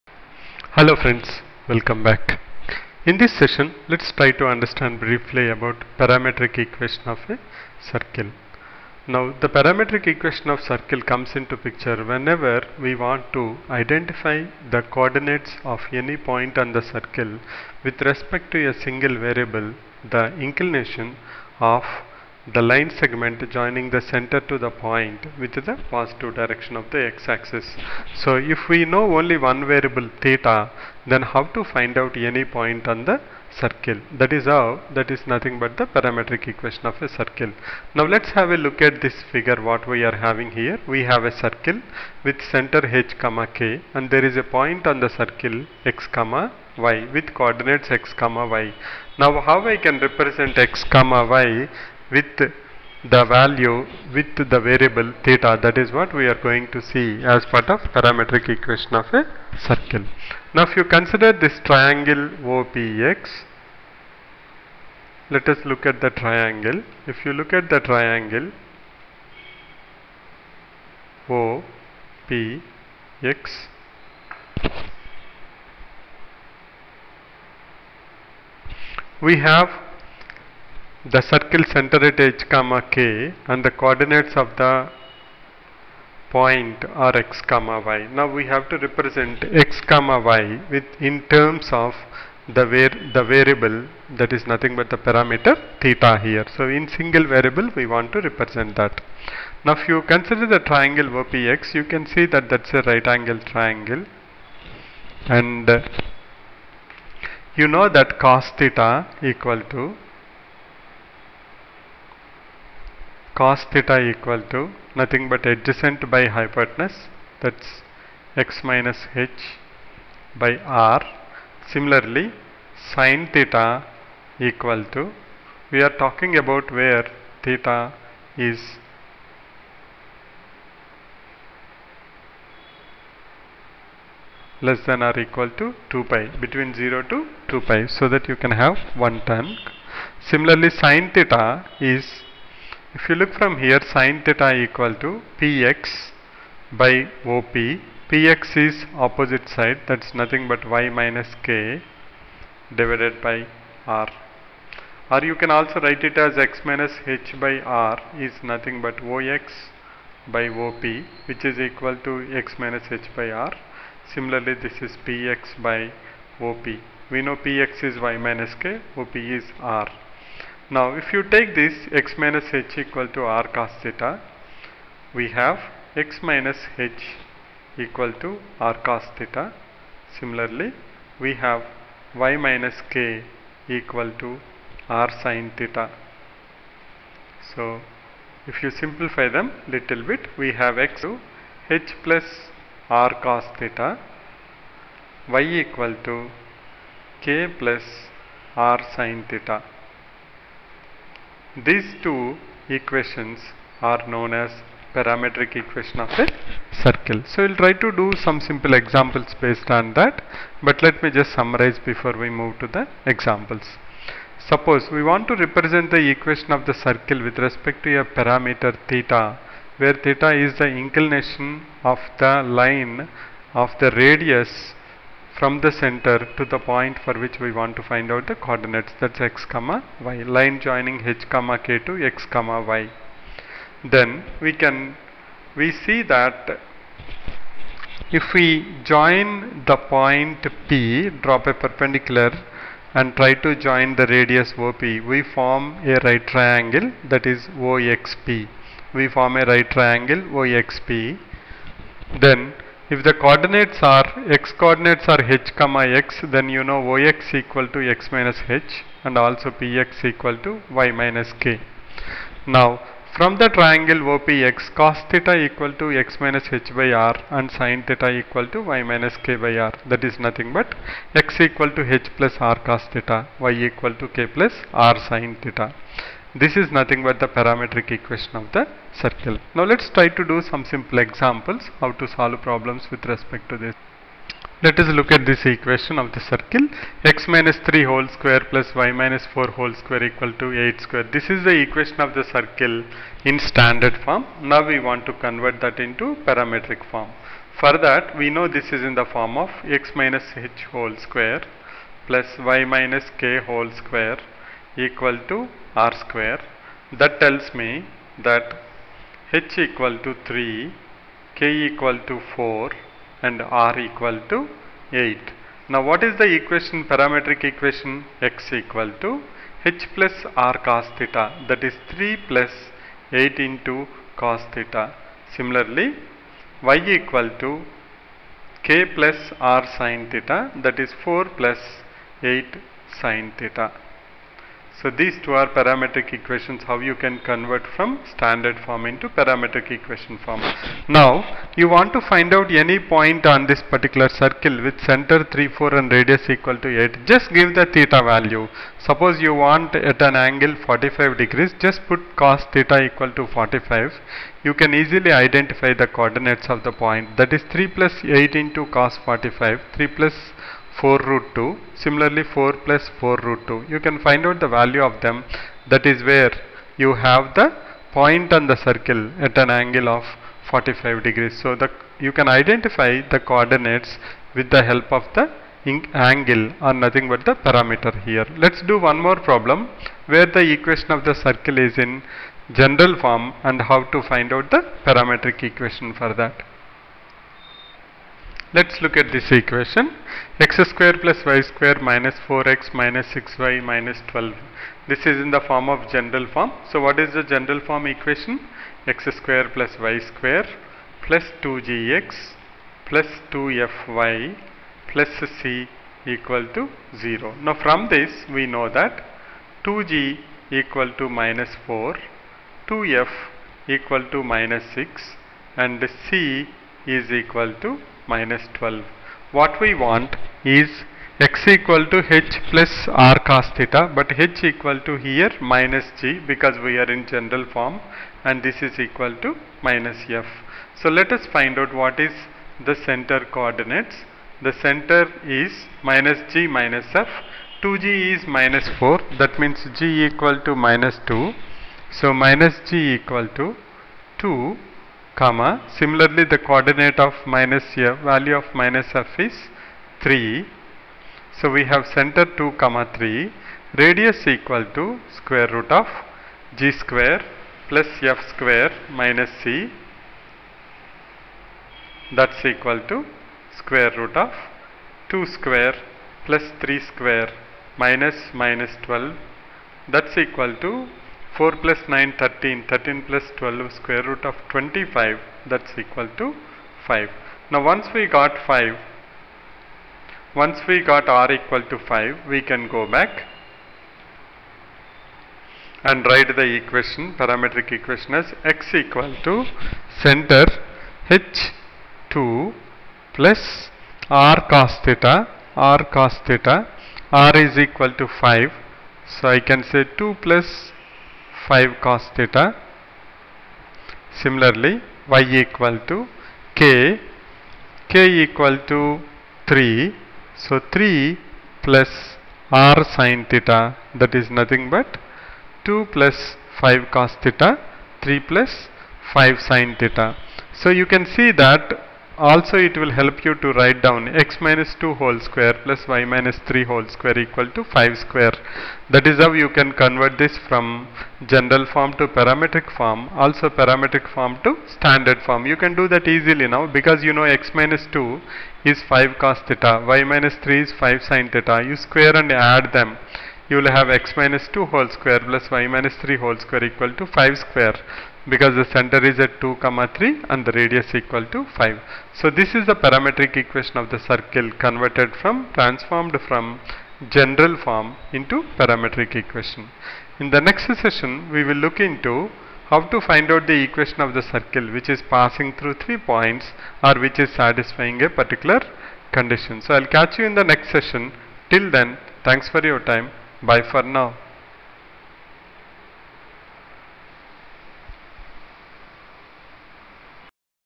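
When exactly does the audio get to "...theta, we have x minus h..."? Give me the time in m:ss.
2:53.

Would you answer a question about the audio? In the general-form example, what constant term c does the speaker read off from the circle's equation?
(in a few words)
-12.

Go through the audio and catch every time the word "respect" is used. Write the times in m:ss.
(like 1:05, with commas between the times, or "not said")
0:18, 3:37, 4:43.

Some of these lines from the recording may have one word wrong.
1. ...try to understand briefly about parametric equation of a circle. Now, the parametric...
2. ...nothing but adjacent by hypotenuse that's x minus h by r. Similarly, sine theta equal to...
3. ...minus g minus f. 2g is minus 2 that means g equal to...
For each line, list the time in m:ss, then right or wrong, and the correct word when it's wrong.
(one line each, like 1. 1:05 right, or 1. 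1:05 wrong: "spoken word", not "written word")
1. 0:04 right
2. 1:55 right
3. 7:15 wrong: "4", not "2".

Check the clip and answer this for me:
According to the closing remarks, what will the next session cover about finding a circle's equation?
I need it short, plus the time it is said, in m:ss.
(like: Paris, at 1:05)
passing through three points, at 9:25.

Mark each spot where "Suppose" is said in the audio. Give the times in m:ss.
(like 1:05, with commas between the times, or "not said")
3:34, 5:48.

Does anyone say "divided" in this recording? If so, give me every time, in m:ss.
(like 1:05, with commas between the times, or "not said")
2:32.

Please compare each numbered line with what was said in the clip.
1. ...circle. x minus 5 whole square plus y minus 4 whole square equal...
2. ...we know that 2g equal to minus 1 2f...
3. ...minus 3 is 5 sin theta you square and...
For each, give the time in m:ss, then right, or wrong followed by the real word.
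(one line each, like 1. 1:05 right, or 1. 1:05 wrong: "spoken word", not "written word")
1. 4:46 wrong: "3", not "5"
2. 6:48 wrong: "4", not "1"
3. 9:00 right.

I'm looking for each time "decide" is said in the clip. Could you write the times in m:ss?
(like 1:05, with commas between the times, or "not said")
not said.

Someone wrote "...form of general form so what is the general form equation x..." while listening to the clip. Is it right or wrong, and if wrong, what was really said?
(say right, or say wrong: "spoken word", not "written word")
right.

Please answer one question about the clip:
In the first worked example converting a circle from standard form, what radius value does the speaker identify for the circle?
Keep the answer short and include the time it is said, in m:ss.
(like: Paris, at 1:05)
8, at 5:13.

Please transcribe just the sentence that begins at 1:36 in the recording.
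So in single variable we want to represent that.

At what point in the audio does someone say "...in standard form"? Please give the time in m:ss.
4:53.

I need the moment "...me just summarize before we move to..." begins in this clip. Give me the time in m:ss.
3:31.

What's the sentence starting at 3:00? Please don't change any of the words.
Similarly, we have y minus k equal to r sin theta.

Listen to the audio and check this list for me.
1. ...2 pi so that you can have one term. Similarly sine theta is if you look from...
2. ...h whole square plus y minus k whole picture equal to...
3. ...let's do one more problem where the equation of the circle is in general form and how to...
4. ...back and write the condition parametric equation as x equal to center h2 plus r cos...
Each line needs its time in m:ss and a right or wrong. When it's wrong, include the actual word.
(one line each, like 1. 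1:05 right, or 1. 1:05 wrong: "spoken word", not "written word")
1. 2:17 right
2. 5:00 wrong: "square", not "picture"
3. 6:18 right
4. 8:02 wrong: "equation", not "condition".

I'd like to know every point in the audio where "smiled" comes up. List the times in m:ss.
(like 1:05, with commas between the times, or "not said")
not said.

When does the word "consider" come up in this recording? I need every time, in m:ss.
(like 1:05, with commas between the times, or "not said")
1:00, 1:40.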